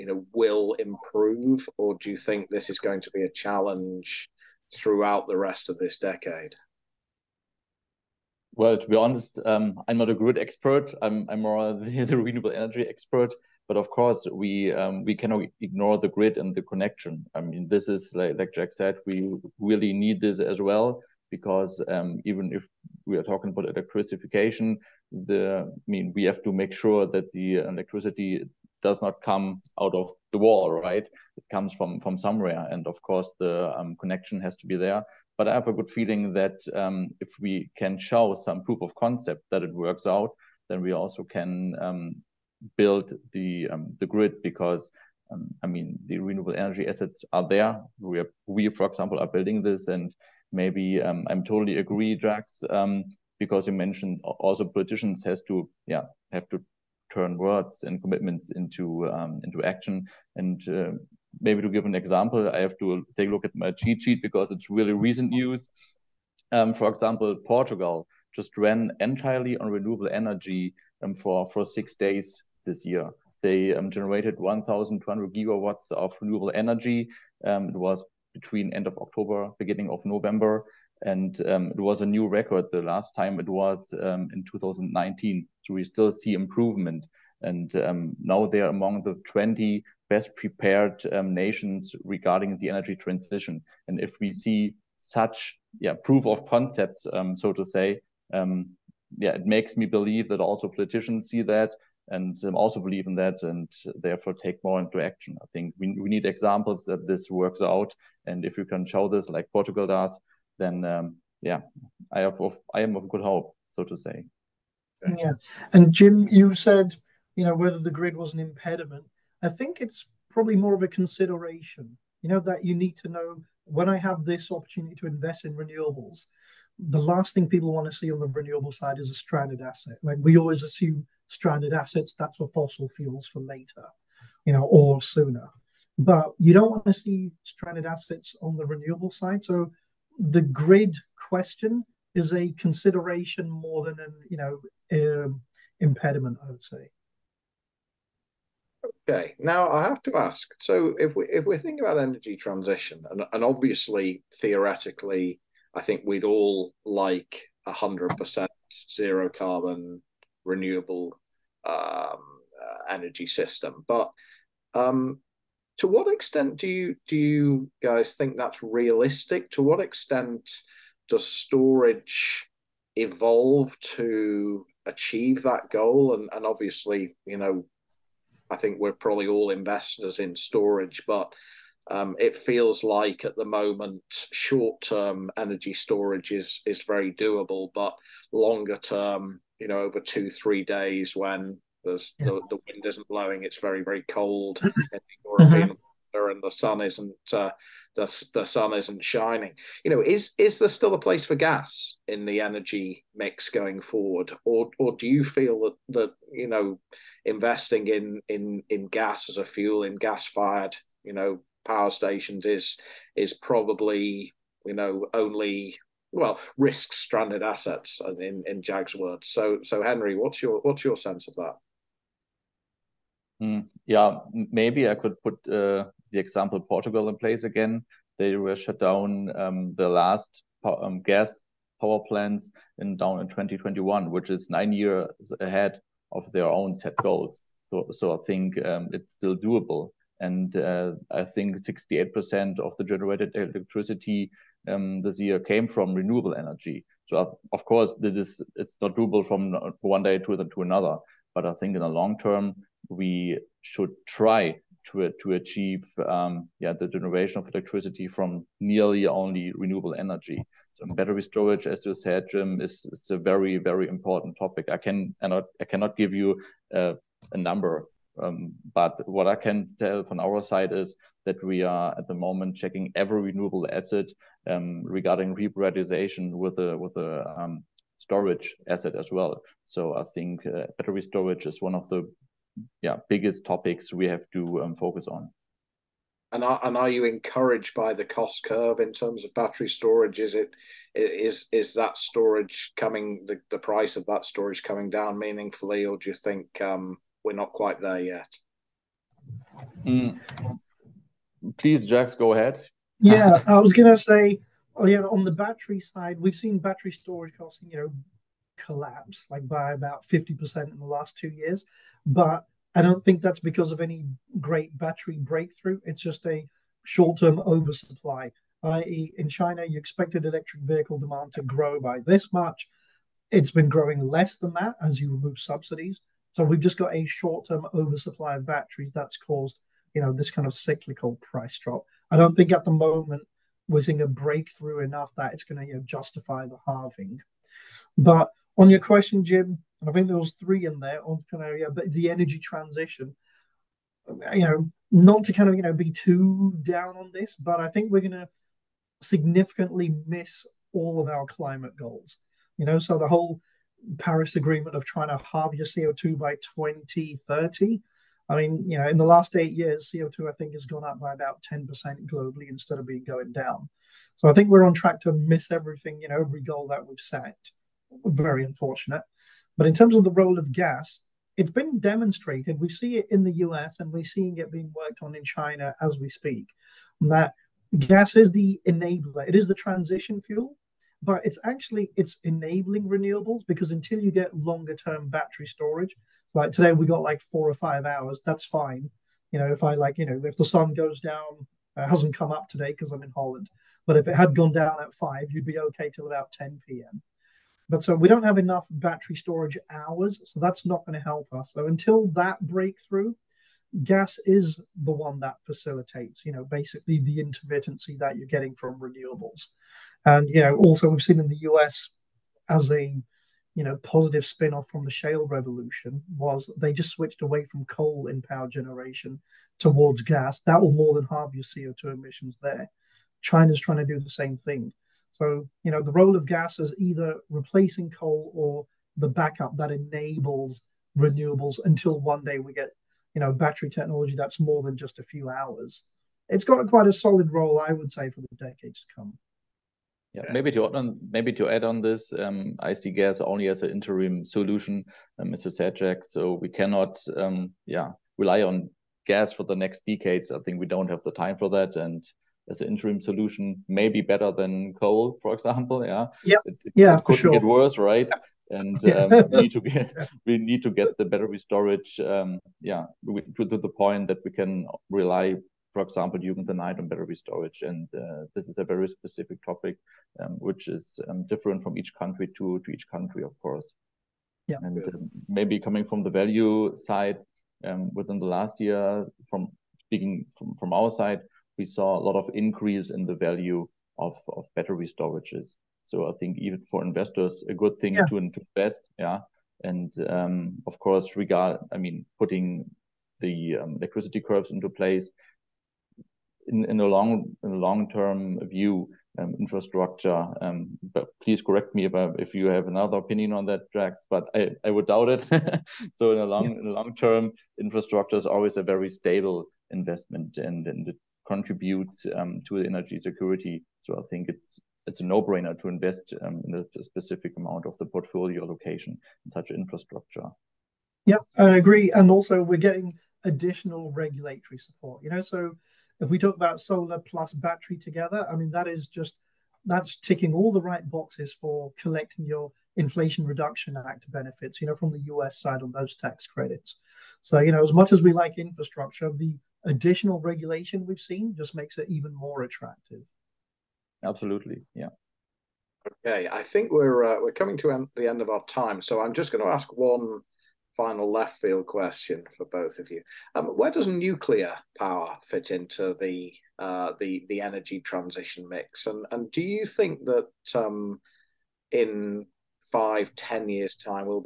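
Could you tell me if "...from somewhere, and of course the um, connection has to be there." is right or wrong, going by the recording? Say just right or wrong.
right.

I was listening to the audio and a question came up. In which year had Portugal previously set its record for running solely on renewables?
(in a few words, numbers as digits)
2019.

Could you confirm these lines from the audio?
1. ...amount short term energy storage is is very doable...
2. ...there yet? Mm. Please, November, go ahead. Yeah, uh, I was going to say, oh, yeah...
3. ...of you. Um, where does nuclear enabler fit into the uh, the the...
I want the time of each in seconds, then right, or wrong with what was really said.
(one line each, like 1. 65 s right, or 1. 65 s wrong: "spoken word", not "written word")
1. 183 s wrong: "moment", not "amount"
2. 297 s wrong: "Jags", not "November"
3. 552 s wrong: "power", not "enabler".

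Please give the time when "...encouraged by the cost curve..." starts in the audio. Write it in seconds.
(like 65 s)
287 s.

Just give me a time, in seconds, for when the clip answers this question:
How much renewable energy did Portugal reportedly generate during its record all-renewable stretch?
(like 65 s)
74 s.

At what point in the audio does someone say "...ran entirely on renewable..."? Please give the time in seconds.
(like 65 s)
68 s.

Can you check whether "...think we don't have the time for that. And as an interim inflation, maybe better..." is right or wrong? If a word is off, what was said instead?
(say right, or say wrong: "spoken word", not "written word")
wrong: "solution", not "inflation".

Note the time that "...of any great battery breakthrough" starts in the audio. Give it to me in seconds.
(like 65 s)
313 s.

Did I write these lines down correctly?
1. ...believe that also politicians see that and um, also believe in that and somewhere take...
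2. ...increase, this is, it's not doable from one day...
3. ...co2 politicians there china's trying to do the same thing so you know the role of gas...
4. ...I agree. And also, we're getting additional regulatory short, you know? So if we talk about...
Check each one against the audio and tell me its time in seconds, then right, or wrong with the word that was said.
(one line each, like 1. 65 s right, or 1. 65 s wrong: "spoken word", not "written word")
1. 99 s wrong: "therefore", not "somewhere"
2. 247 s wrong: "course", not "increase"
3. 421 s wrong: "emissions", not "politicians"
4. 521 s wrong: "support", not "short".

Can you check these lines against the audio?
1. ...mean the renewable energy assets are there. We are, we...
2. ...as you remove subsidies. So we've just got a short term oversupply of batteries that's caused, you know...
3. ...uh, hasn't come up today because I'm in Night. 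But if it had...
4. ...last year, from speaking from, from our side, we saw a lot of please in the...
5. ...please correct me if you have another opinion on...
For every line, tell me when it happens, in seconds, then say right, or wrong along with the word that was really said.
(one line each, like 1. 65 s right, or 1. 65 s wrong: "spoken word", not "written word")
1. 45 s right
2. 324 s right
3. 391 s wrong: "Holland", not "Night"
4. 478 s wrong: "increase", not "please"
5. 501 s right.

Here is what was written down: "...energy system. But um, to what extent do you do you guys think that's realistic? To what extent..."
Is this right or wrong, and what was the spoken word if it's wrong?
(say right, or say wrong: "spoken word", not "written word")
right.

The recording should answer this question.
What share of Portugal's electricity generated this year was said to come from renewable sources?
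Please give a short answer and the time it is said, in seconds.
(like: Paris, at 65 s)
68%, at 241 s.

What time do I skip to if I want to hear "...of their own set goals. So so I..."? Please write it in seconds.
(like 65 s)
236 s.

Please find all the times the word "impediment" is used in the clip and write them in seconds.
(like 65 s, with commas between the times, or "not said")
118 s, 145 s.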